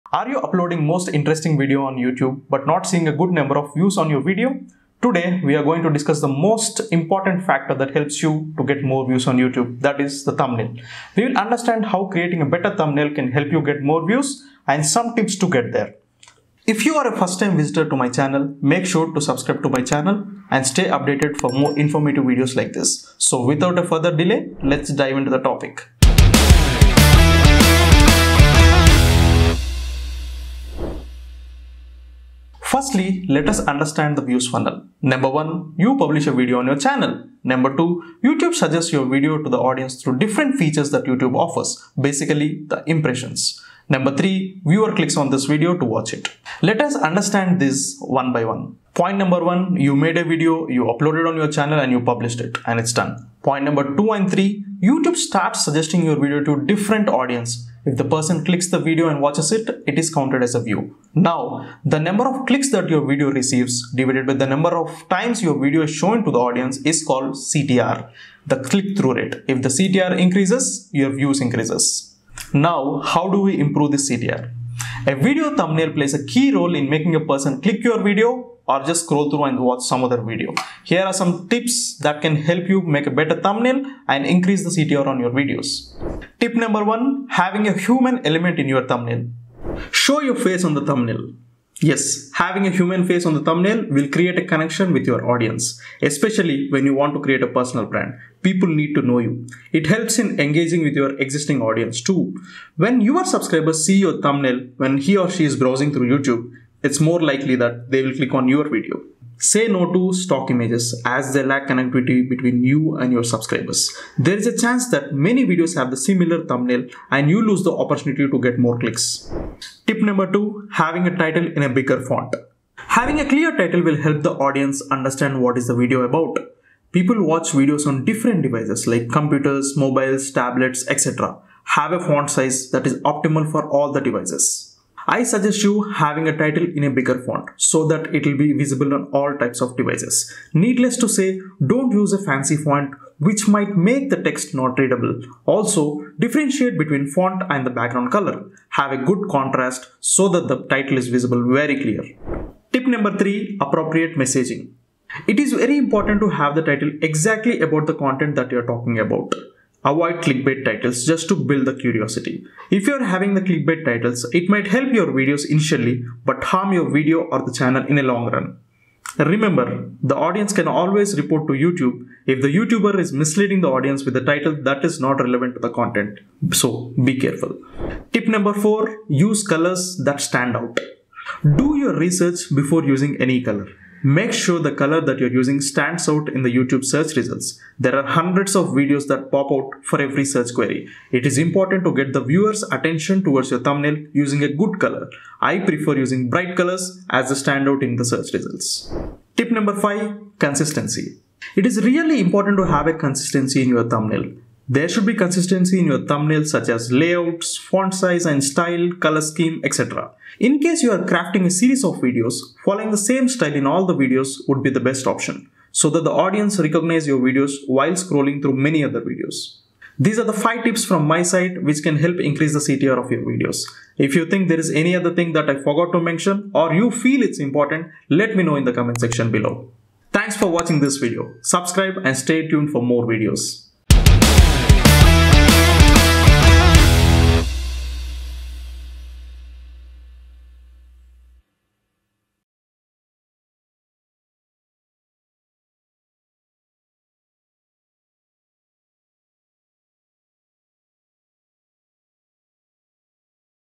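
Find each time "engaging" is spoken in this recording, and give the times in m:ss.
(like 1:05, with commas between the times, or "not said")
1:40.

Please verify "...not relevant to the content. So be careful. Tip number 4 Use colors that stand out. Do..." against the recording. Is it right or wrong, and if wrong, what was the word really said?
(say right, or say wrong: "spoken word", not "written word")
right.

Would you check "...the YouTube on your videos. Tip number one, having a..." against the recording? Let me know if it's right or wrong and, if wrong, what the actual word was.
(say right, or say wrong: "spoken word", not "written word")
wrong: "CTR", not "YouTube".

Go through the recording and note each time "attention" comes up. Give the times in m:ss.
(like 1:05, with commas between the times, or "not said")
3:12.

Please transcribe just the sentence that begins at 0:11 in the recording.
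We will understand how creating a better thumbnail can help you get more views and some tips to get there.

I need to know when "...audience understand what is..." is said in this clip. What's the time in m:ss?
2:04.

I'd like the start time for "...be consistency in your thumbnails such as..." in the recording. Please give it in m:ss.
3:25.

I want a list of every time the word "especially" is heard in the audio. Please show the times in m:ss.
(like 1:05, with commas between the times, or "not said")
1:36.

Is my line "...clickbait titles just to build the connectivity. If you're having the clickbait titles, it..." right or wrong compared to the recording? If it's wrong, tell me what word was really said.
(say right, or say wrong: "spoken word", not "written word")
wrong: "curiosity", not "connectivity".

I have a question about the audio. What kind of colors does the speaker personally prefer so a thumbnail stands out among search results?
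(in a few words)
bright colors.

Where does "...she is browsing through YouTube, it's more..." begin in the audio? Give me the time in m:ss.
1:45.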